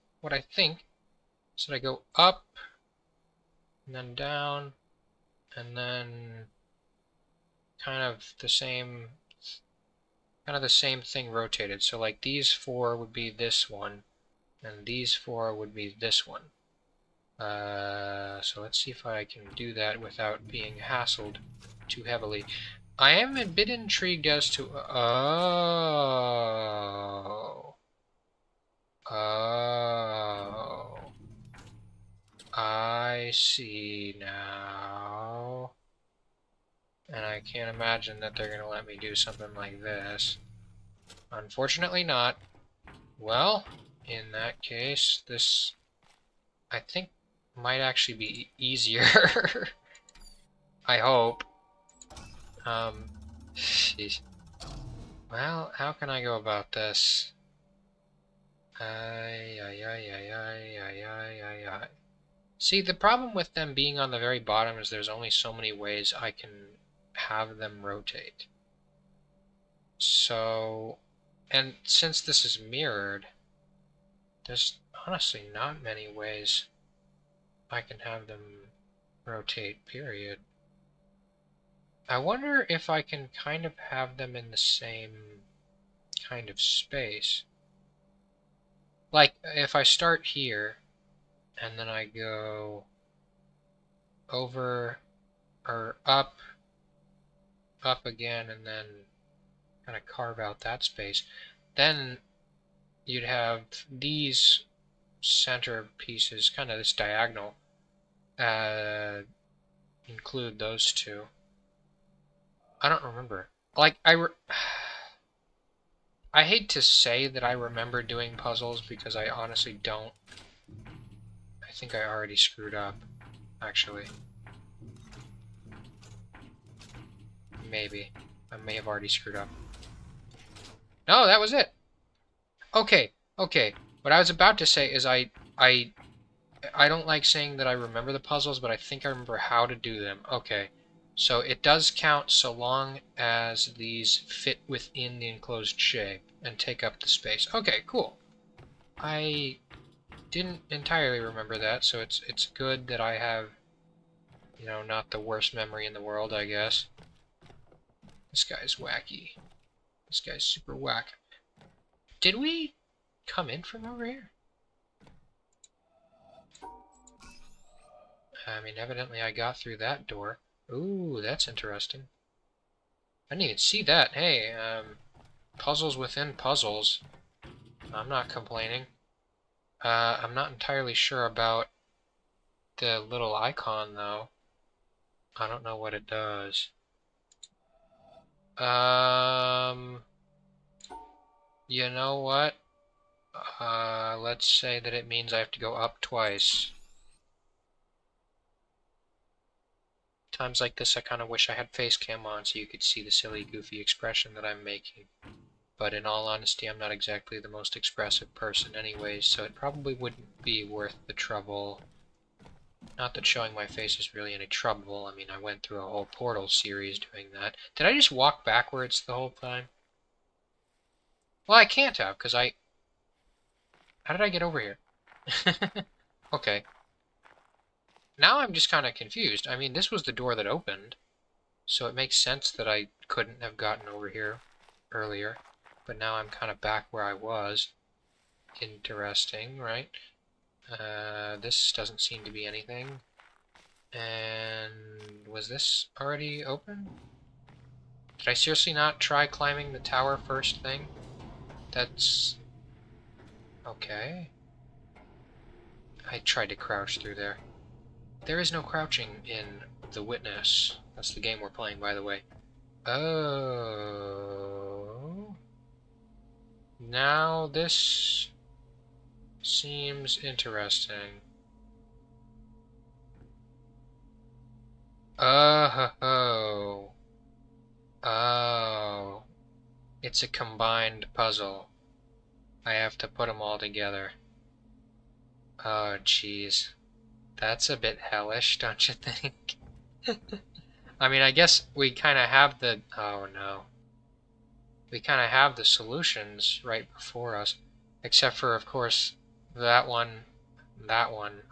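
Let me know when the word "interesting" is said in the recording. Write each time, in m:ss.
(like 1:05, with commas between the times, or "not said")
2:51, 3:58, 4:30.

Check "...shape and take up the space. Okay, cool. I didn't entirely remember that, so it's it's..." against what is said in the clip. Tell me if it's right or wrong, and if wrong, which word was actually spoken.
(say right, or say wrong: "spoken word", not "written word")
right.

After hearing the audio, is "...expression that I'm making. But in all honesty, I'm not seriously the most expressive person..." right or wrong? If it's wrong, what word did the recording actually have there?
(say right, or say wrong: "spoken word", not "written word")
wrong: "exactly", not "seriously".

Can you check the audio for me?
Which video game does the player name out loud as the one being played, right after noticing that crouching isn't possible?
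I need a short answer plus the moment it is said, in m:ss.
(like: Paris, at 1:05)
The Witness, at 4:19.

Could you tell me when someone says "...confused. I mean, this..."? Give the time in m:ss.
3:48.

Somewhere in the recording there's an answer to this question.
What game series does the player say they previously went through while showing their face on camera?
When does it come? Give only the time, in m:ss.
3:36.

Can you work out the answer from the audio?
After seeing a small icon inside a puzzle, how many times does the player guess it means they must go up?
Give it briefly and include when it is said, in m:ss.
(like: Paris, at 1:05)
2, at 3:16.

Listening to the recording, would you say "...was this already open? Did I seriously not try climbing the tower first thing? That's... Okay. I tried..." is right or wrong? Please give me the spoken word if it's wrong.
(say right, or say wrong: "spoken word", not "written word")
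right.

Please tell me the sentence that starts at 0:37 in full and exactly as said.
And I can't imagine that they're going to let me do something like this.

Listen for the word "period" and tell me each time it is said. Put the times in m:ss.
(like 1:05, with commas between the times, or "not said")
1:19.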